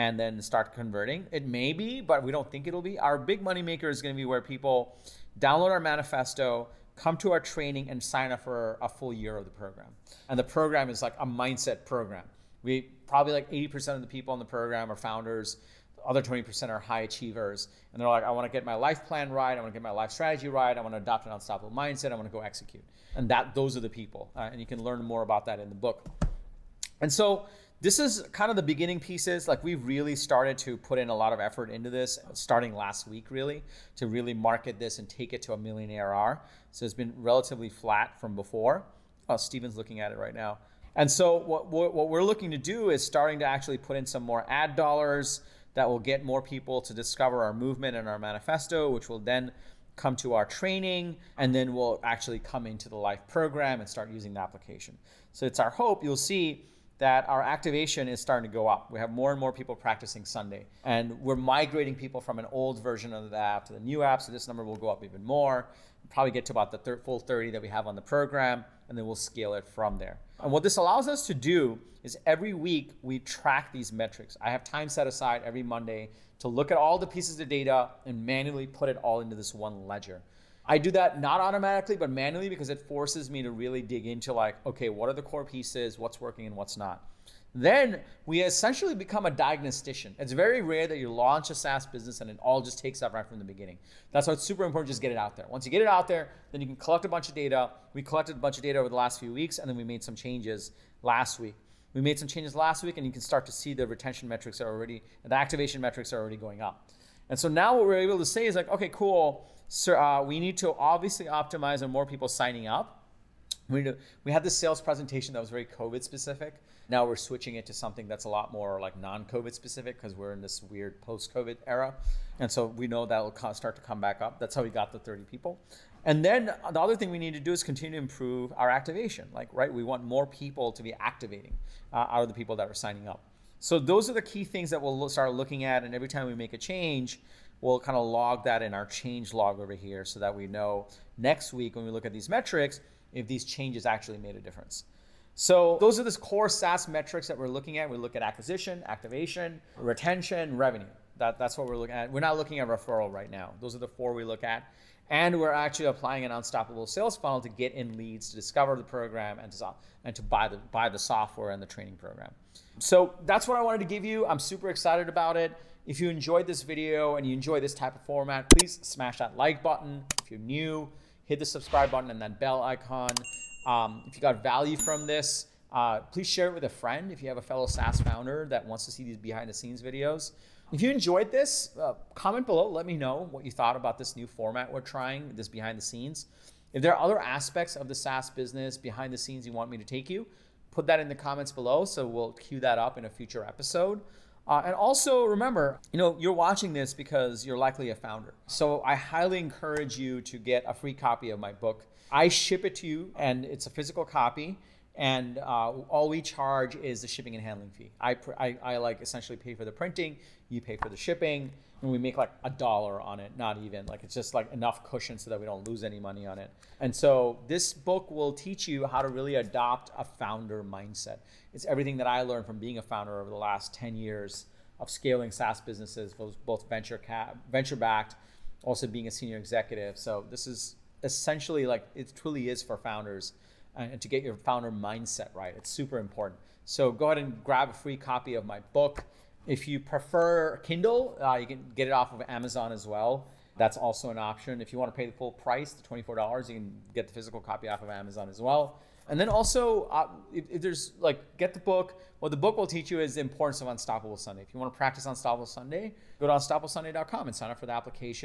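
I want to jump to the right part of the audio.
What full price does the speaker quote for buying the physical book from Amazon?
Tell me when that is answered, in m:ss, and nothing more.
4:05.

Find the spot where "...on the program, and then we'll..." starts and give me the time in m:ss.
1:07.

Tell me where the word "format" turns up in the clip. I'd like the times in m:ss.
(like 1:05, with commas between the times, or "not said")
2:48, 3:04.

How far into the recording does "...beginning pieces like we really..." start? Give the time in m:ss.
0:28.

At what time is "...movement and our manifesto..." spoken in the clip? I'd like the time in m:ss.
0:47.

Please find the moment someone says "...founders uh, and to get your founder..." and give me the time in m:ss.
3:52.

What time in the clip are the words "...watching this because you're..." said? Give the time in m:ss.
3:16.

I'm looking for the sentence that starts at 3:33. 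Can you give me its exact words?
Like it's just like enough cushion so that we don't lose any money on it.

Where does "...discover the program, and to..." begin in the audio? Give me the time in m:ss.
2:38.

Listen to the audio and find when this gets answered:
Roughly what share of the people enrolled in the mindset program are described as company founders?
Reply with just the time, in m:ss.
0:13.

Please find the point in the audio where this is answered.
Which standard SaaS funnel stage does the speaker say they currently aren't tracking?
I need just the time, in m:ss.
2:32.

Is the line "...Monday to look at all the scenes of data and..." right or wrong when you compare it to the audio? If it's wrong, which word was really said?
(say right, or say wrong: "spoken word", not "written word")
wrong: "pieces", not "scenes".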